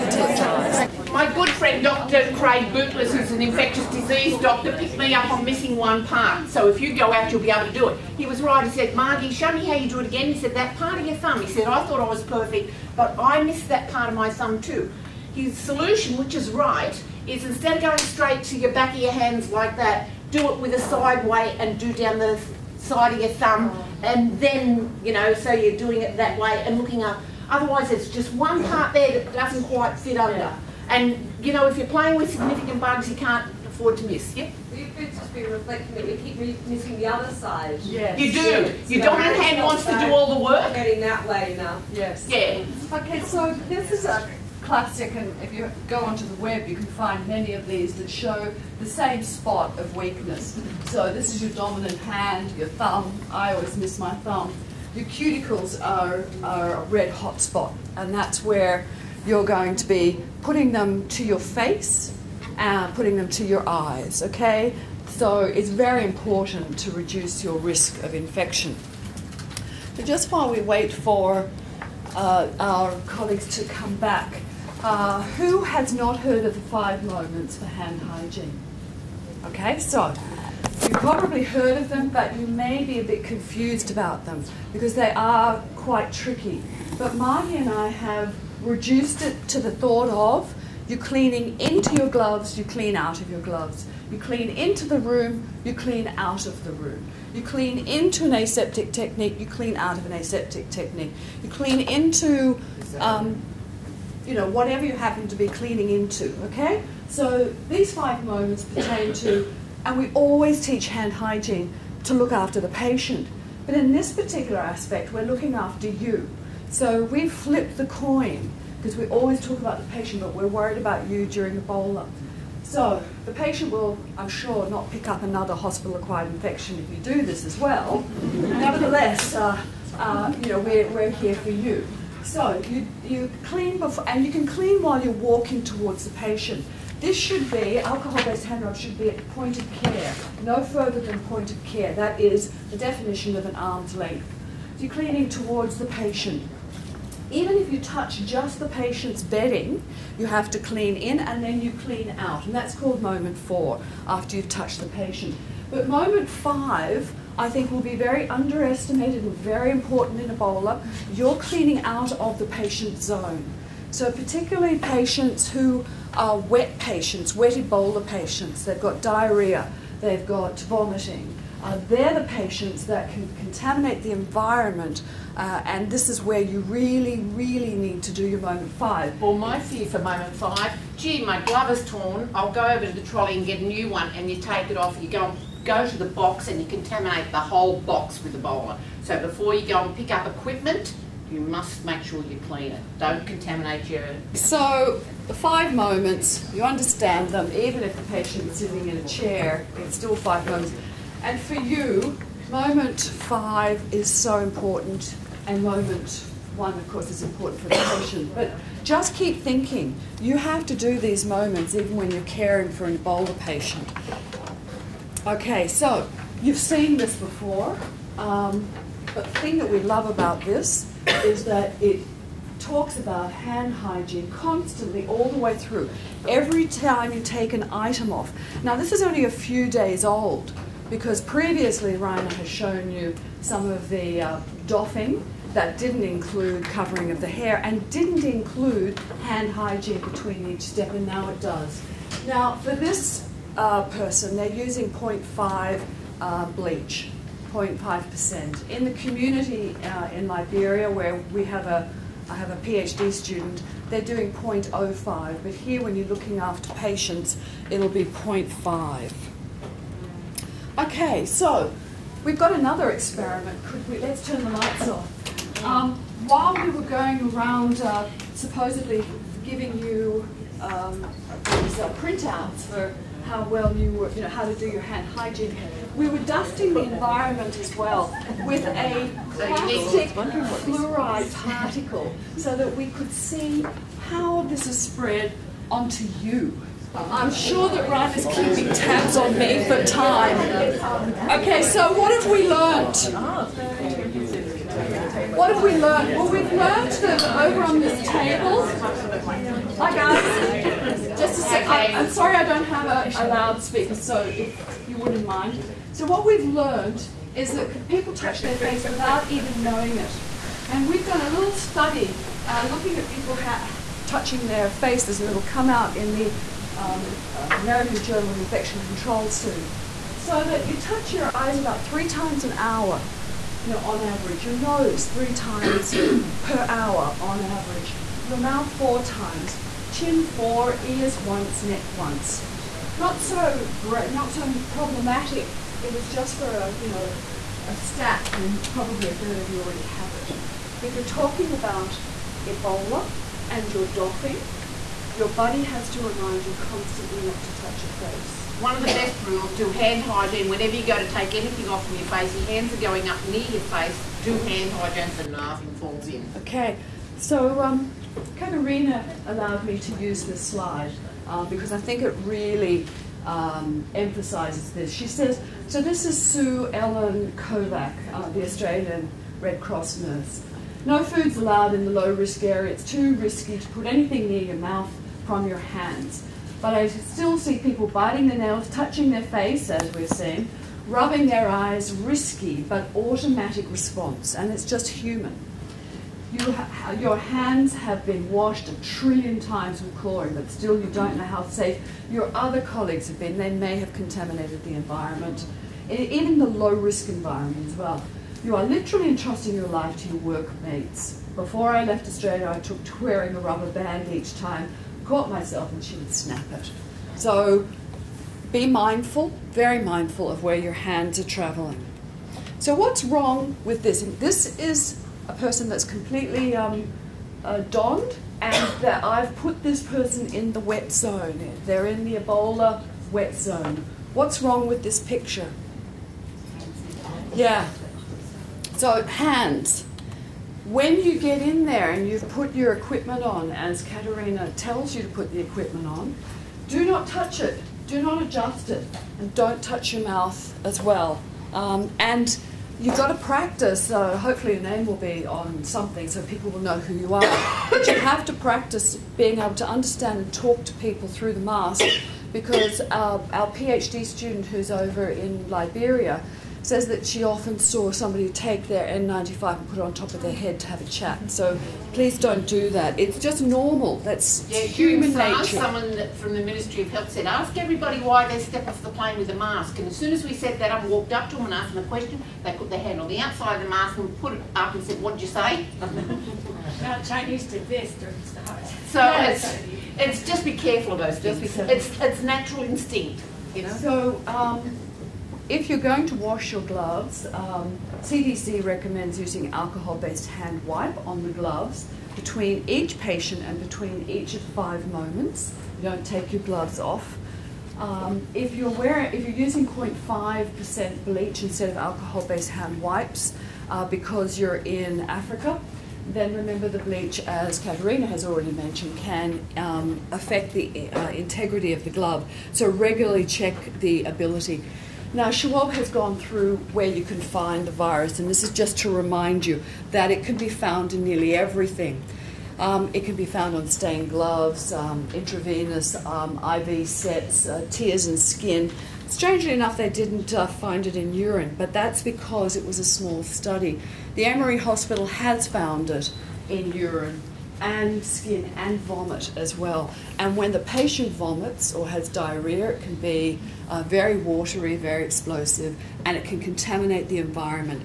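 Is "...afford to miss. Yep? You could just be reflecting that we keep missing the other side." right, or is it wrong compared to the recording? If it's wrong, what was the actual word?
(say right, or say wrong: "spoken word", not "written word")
right.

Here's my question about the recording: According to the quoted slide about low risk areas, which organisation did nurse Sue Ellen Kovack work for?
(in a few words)
Australian Red Cross.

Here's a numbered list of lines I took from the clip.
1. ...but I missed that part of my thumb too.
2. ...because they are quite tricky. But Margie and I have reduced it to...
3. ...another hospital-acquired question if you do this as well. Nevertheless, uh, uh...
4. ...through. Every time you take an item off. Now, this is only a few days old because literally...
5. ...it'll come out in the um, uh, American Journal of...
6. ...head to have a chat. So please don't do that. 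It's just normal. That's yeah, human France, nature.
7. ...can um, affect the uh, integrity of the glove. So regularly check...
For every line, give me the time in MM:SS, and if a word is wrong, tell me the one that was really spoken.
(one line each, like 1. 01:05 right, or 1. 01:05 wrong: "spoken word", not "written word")
1. 00:12 right
2. 01:24 right
3. 02:05 wrong: "infection", not "question"
4. 03:45 wrong: "previously", not "literally"
5. 05:15 right
6. 07:40 right
7. 08:28 right.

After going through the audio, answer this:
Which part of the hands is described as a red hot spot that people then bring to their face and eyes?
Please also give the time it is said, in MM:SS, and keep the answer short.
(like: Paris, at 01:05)
cuticles, at 00:54.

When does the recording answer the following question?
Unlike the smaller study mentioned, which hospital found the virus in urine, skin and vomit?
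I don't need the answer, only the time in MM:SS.
08:54.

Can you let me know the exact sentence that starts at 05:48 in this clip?
One of the best rules, do hand hygiene.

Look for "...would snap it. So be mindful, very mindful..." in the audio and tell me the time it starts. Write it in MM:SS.
06:45.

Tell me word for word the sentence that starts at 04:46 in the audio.
I'm sure that Ryan is keeping tabs on me for time.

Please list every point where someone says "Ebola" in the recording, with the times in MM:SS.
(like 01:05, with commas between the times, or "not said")
02:01, 02:40, 02:47, 03:08, 03:32, 05:42, 07:02.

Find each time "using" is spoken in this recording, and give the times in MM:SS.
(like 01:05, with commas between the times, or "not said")
04:04, 08:09, 08:19.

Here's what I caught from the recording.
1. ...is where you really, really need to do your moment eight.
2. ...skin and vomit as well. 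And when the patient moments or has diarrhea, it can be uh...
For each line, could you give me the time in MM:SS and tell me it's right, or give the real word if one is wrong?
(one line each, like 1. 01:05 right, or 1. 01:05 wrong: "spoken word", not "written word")
1. 02:56 wrong: "five", not "eight"
2. 08:58 wrong: "vomits", not "moments".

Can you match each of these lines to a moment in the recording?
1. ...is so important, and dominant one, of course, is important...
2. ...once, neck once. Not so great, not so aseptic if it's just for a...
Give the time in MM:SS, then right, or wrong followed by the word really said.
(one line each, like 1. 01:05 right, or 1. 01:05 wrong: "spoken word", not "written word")
1. 03:23 wrong: "moment", not "dominant"
2. 05:31 wrong: "problematic", not "aseptic".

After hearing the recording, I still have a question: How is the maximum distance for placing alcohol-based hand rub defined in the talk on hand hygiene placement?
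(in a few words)
an arm's length.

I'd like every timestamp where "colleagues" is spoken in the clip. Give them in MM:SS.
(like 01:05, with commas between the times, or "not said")
01:13, 06:32.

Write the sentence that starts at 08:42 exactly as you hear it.
Um, it can be found on stained gloves, um, intravenous um, IV sets, uh, tears and skin.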